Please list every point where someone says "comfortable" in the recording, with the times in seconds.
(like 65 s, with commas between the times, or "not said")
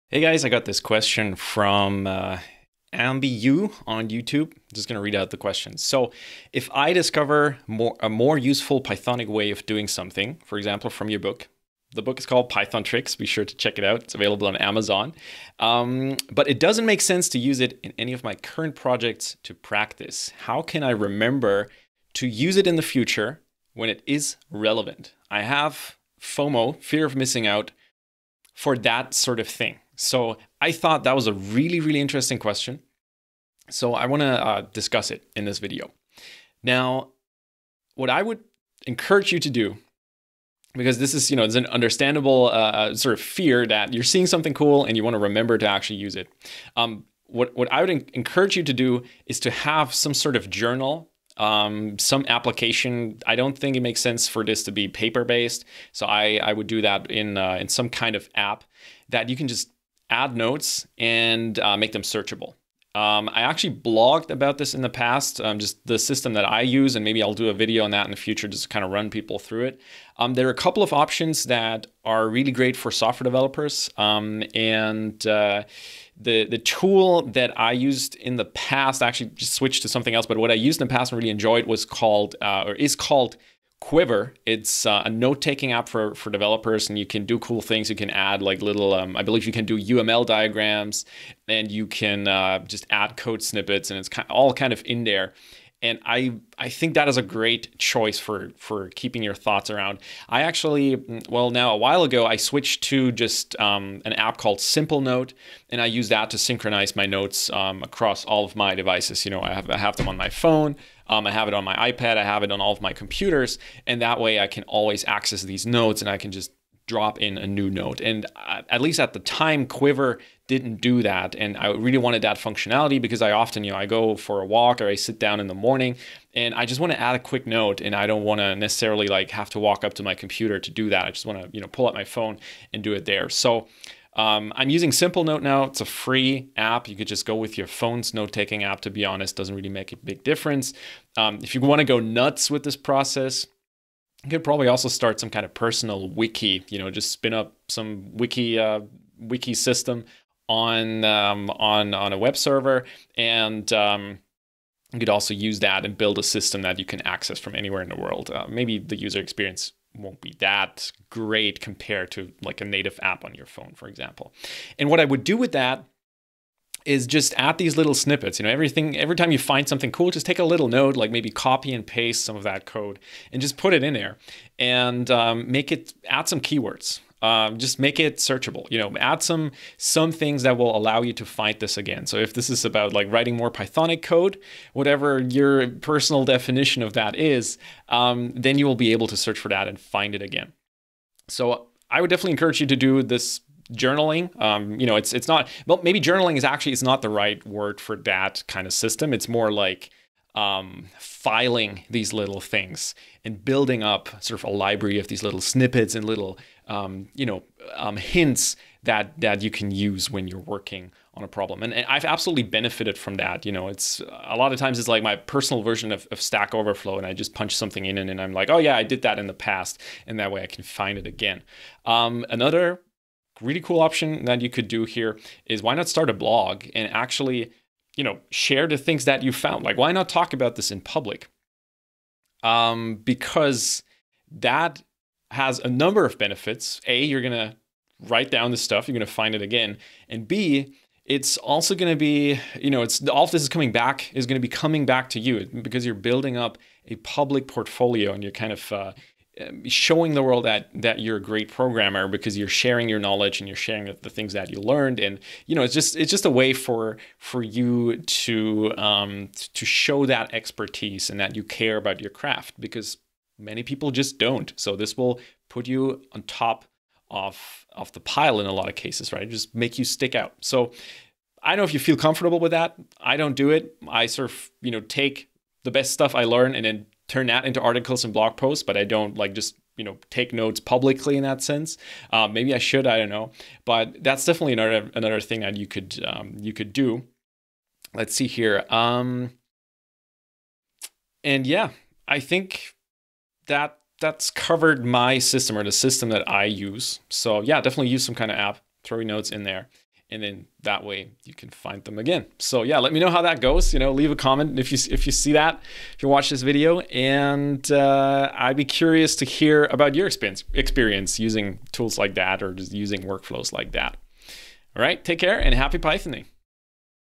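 271 s.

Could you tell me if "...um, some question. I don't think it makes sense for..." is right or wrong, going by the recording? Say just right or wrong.
wrong.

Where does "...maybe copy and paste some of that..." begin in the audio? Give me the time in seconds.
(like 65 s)
171 s.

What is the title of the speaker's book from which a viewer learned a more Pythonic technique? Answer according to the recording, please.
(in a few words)
Python Tricks.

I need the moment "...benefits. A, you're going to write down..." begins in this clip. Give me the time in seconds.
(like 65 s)
236 s.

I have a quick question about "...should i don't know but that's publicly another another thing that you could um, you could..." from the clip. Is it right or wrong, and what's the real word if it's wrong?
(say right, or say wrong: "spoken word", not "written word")
wrong: "definitely", not "publicly".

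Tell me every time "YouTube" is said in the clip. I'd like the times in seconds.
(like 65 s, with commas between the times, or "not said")
4 s.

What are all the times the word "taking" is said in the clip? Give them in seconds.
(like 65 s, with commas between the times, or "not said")
85 s, 138 s.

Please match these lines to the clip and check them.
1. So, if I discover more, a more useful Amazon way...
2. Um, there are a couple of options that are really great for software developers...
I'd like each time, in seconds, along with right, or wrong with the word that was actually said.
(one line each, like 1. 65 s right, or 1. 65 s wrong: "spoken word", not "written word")
1. 5 s wrong: "Pythonic", not "Amazon"
2. 70 s right.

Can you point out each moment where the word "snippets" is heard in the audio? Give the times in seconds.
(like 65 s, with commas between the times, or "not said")
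93 s, 167 s, 205 s.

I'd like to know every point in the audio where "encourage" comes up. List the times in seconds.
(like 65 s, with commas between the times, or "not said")
38 s, 48 s, 192 s.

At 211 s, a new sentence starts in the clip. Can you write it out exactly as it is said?
And, and, I've absolutely benefited from that.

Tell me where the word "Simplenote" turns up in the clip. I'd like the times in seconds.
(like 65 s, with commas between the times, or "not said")
104 s, 134 s.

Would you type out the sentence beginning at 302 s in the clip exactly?
So yeah, let me know how that goes.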